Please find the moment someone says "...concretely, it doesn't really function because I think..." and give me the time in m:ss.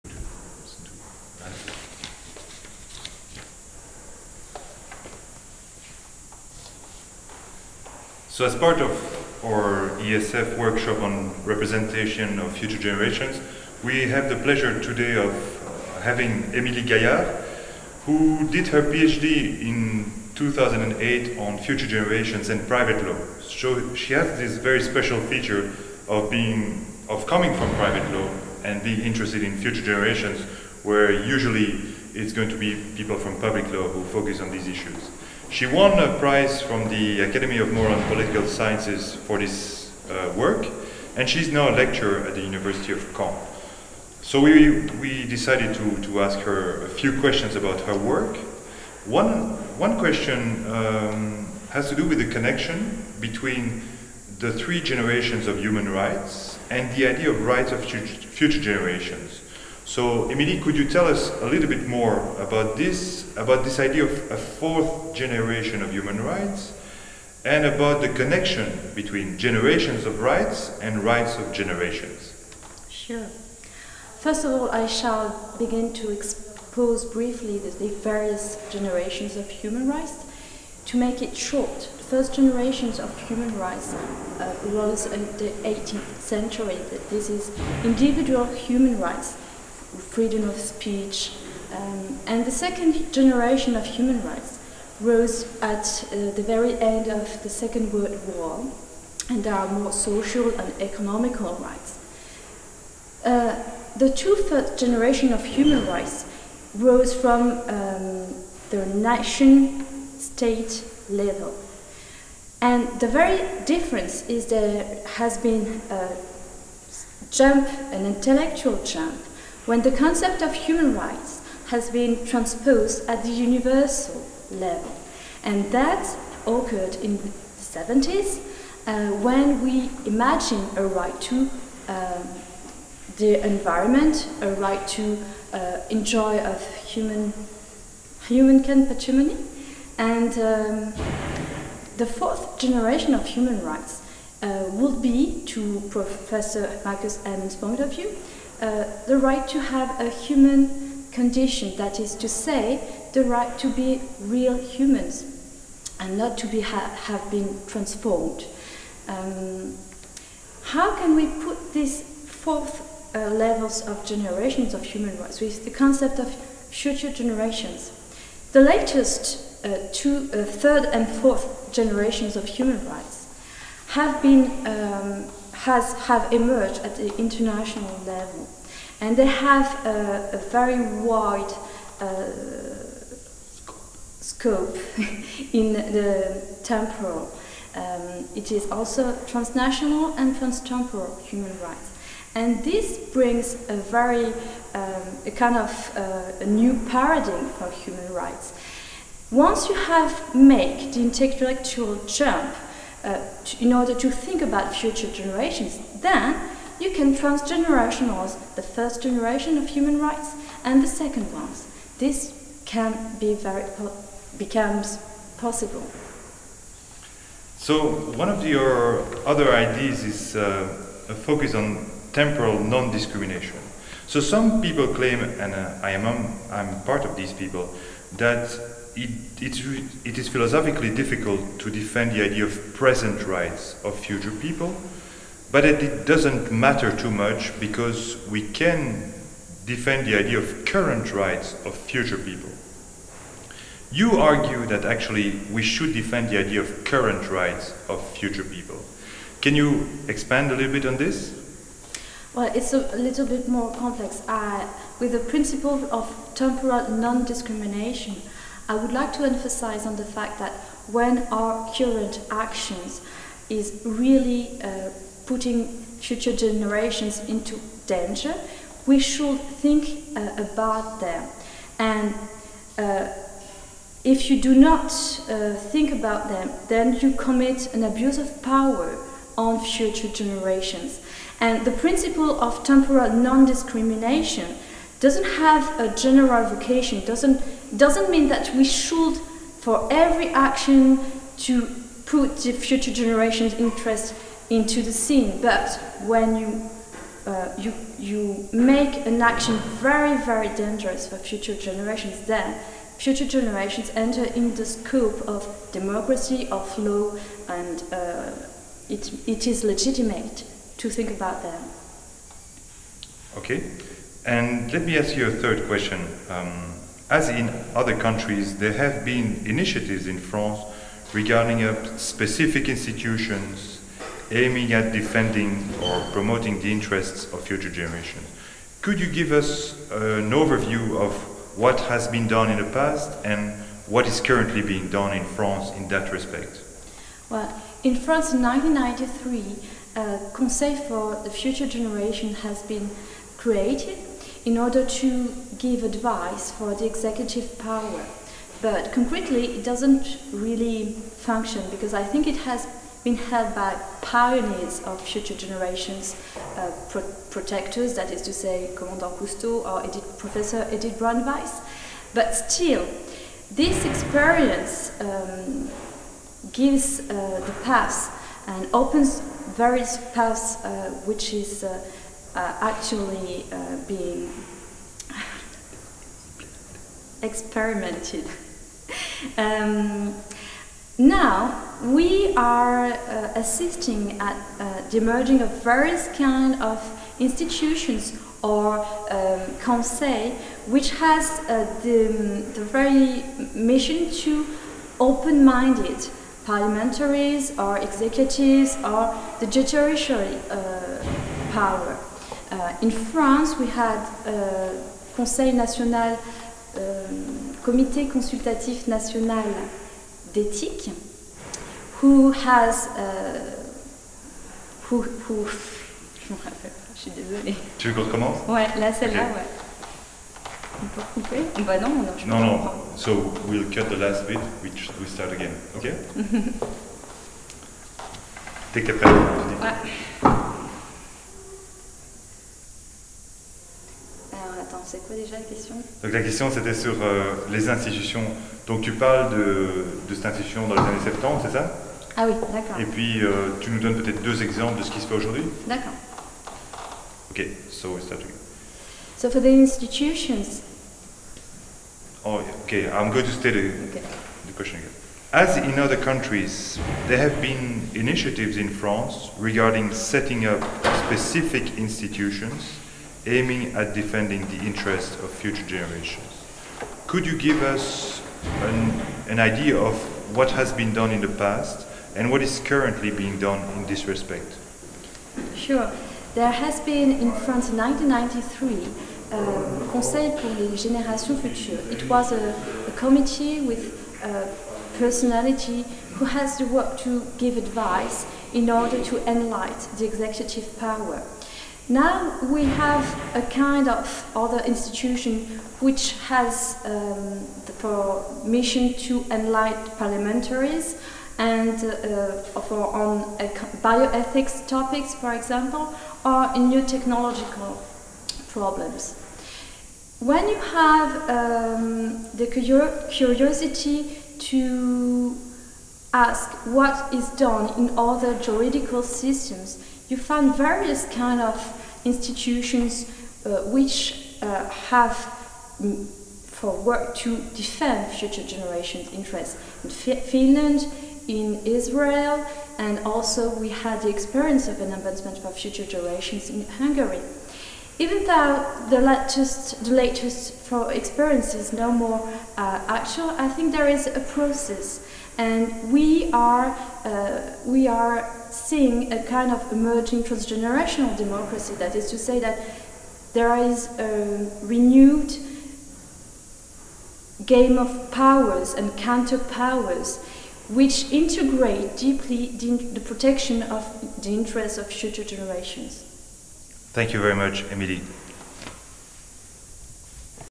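5:48.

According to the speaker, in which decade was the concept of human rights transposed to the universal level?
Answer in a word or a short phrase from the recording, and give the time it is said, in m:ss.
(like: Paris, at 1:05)
the 70s, at 2:07.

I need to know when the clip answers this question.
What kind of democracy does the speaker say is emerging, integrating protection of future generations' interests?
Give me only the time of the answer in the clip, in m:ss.
9:10.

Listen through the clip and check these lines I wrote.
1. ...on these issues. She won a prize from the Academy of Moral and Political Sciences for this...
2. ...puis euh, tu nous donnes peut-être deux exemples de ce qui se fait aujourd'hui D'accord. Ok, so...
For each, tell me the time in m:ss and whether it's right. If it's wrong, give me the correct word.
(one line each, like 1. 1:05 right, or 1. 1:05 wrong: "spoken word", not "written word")
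1. 0:34 right
2. 7:22 right.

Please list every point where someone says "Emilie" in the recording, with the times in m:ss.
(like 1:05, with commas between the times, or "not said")
0:16, 1:00, 9:27.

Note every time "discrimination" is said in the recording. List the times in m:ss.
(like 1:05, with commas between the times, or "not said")
3:42, 4:17, 4:43.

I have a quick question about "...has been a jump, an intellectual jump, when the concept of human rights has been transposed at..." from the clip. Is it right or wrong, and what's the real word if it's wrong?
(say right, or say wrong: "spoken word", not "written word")
right.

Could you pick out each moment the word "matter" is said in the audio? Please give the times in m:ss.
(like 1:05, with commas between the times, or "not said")
3:56.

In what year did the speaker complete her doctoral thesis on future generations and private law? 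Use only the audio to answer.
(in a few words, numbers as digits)
2008.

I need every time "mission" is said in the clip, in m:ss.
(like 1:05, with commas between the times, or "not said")
6:33, 8:18.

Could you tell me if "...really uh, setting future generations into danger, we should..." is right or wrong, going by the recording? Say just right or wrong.
wrong.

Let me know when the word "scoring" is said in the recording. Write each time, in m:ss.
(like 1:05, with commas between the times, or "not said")
not said.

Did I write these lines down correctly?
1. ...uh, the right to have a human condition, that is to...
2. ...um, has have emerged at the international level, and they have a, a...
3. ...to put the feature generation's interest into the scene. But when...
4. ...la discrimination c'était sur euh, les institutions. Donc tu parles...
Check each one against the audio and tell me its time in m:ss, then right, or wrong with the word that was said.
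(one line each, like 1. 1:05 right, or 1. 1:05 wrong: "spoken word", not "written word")
1. 2:28 right
2. 2:54 right
3. 4:51 wrong: "future", not "feature"
4. 7:16 wrong: "question", not "discrimination".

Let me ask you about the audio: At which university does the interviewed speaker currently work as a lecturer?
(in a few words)
University of Caen.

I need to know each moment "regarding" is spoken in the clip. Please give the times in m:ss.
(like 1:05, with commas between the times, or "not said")
5:21, 7:39.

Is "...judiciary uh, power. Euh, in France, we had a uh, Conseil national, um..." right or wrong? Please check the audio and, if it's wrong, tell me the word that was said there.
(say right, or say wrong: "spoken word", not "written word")
right.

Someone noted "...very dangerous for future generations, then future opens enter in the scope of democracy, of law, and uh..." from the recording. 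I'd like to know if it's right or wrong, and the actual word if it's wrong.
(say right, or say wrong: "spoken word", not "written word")
wrong: "generations", not "opens".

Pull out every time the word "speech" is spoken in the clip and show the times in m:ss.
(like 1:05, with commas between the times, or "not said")
1:30.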